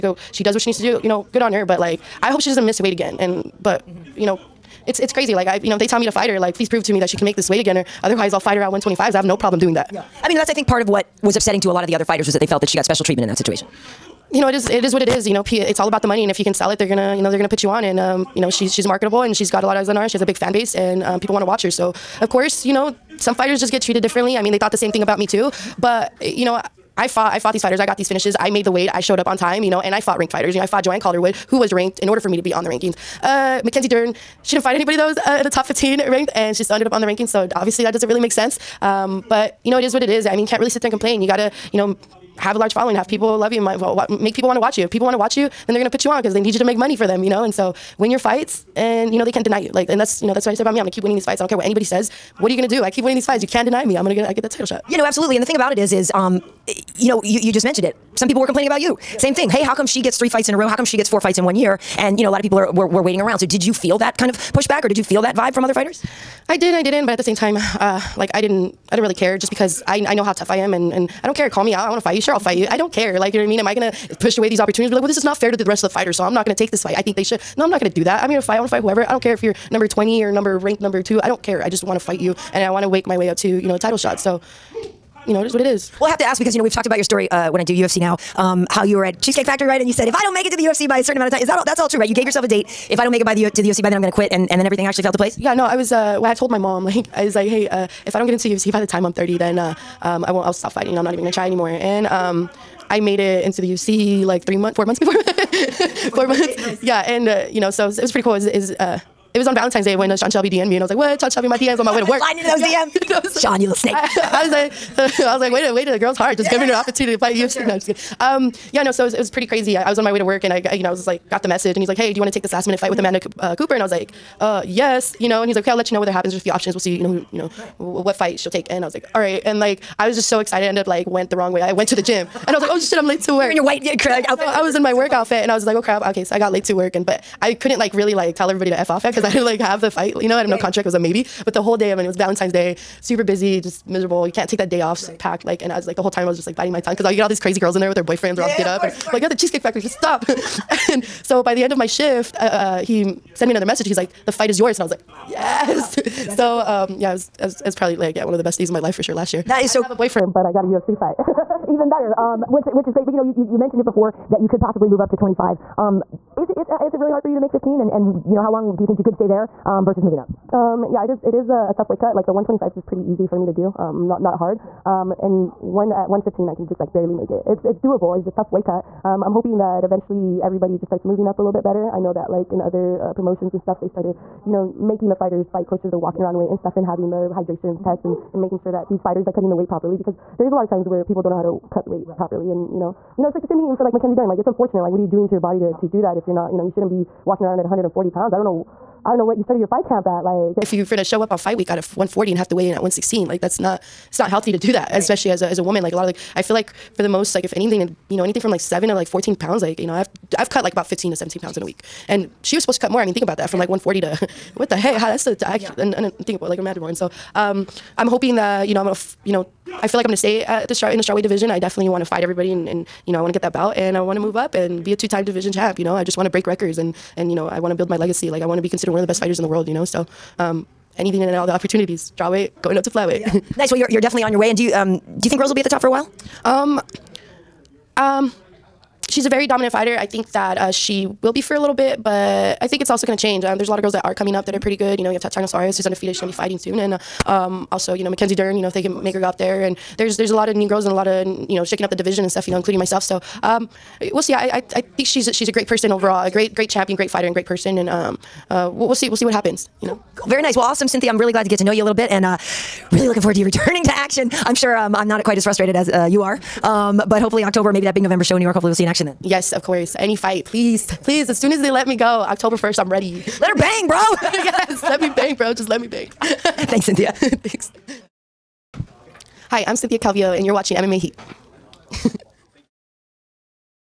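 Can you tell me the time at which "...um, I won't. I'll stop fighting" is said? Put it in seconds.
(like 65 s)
100 s.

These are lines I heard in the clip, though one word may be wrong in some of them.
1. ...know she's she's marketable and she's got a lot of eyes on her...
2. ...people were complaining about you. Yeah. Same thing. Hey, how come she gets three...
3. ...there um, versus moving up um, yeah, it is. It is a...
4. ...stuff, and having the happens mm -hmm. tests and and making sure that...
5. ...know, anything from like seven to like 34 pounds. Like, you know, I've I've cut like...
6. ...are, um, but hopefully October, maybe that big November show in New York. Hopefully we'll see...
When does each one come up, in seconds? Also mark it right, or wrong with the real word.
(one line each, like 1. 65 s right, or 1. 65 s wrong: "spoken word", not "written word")
1. 18 s right
2. 58 s right
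3. 169 s right
4. 186 s wrong: "hydrations", not "happens"
5. 208 s wrong: "14", not "34"
6. 266 s right.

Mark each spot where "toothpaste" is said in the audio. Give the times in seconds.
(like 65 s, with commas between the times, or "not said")
not said.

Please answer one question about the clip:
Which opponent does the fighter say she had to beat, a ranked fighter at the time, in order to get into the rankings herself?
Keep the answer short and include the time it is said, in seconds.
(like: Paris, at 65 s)
Joanne Calderwood, at 30 s.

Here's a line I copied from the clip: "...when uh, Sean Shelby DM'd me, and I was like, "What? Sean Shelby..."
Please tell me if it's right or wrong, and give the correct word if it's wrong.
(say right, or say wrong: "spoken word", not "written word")
right.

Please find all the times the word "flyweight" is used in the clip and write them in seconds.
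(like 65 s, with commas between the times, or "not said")
232 s.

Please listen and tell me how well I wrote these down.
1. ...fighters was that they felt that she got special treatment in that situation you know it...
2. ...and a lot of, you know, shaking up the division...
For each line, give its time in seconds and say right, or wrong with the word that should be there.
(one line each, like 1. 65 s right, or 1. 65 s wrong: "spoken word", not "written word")
1. 12 s right
2. 250 s right.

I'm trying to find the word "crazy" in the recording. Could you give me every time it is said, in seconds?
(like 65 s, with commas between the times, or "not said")
5 s, 119 s, 147 s.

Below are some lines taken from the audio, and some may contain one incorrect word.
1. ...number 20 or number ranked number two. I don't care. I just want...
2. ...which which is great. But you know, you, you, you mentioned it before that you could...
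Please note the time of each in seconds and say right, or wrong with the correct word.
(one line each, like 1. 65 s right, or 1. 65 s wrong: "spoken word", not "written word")
1. 79 s right
2. 162 s right.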